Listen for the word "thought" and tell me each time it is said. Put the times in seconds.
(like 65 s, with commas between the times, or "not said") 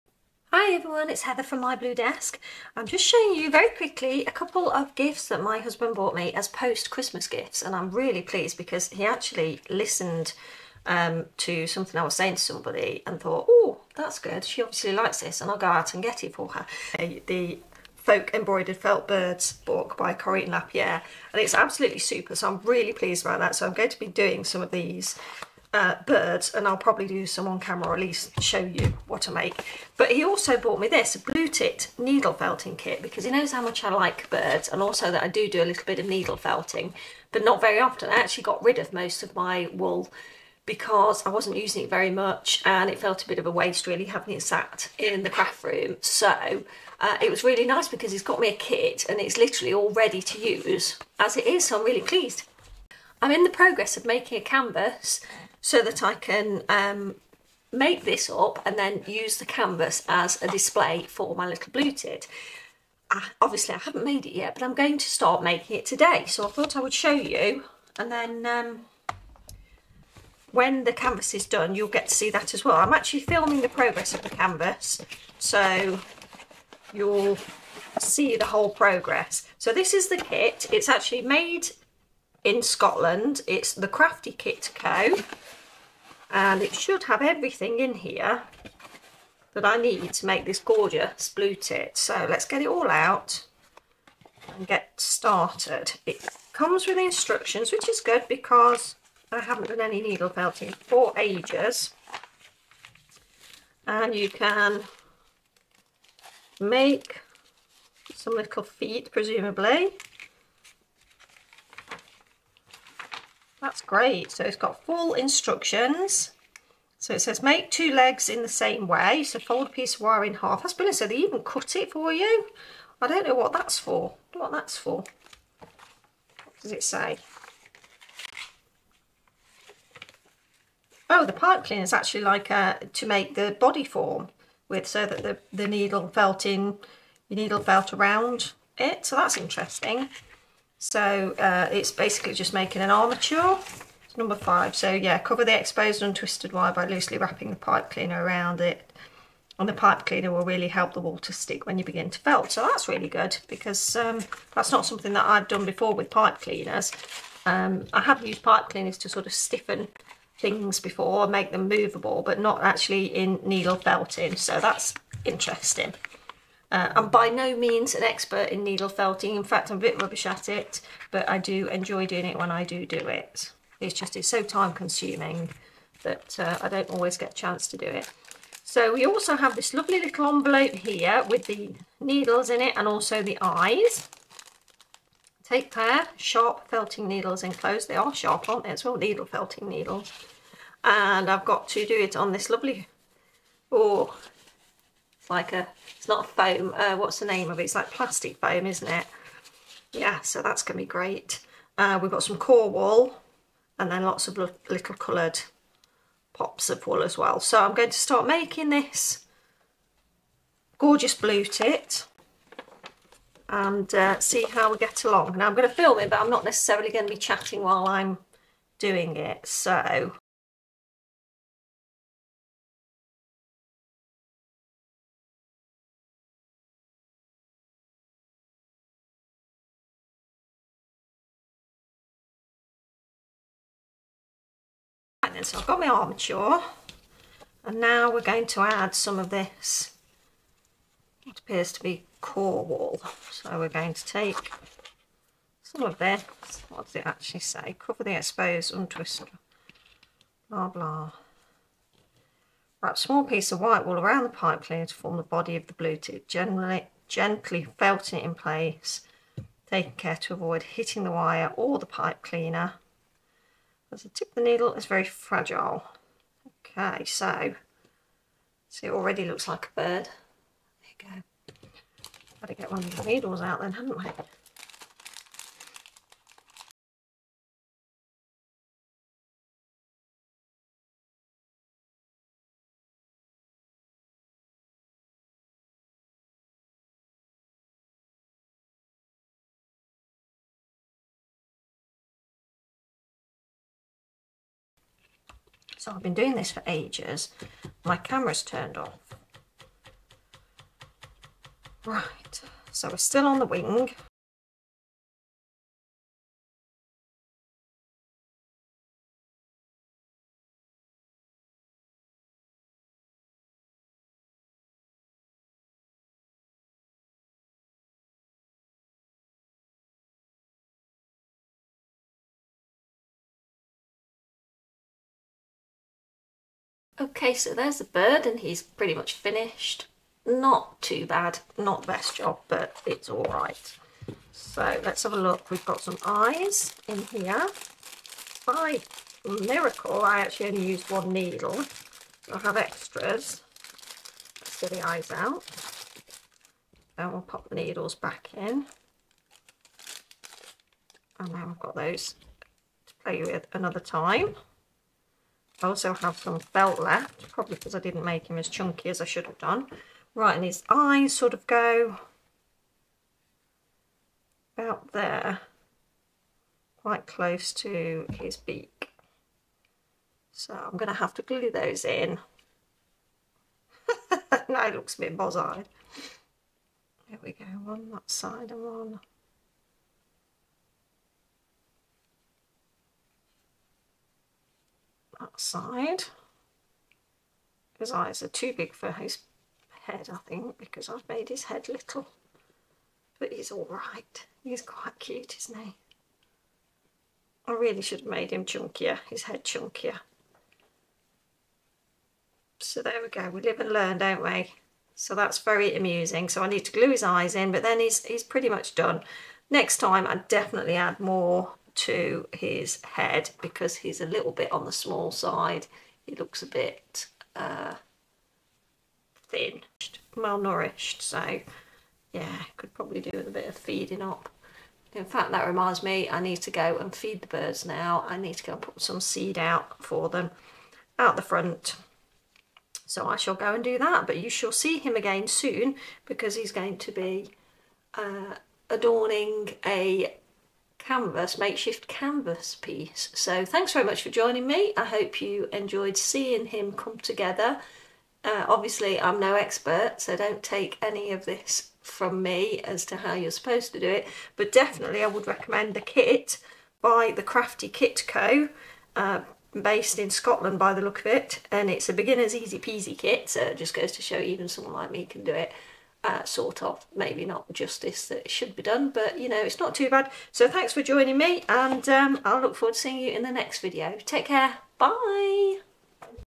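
13 s, 66 s.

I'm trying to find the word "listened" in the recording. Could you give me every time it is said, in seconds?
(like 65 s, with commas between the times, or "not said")
9 s.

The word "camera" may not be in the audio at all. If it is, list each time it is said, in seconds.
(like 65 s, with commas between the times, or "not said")
27 s, 297 s.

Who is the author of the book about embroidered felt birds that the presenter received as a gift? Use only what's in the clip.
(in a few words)
Corinne Lapierre.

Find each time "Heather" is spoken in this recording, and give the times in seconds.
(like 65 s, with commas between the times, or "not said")
1 s.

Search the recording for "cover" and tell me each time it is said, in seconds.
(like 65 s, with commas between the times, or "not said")
145 s, 247 s.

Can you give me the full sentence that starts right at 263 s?
As the tip of the needle is very fragile.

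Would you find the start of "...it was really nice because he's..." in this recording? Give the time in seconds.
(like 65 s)
47 s.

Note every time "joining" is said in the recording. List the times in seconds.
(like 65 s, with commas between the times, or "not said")
444 s, 470 s.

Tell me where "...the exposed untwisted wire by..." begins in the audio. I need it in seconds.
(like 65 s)
145 s.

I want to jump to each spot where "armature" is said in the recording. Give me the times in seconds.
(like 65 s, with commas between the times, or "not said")
142 s, 235 s.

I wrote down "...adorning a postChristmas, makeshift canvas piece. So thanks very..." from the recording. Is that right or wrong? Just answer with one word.
wrong.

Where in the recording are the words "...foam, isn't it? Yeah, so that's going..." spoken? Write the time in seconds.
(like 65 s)
198 s.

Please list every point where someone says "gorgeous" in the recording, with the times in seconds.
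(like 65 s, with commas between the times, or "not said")
90 s, 210 s.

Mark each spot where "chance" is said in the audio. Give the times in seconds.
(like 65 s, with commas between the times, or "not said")
177 s.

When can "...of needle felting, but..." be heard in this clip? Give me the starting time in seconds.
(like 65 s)
35 s.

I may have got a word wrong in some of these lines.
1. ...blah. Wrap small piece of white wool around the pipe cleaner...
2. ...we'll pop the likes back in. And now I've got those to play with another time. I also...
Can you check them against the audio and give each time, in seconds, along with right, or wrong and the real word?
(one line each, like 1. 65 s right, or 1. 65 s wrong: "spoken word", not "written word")
1. 250 s right
2. 347 s wrong: "needles", not "likes".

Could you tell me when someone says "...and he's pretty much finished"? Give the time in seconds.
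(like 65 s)
328 s.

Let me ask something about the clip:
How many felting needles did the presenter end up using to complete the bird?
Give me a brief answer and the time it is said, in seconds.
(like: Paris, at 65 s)
1, at 340 s.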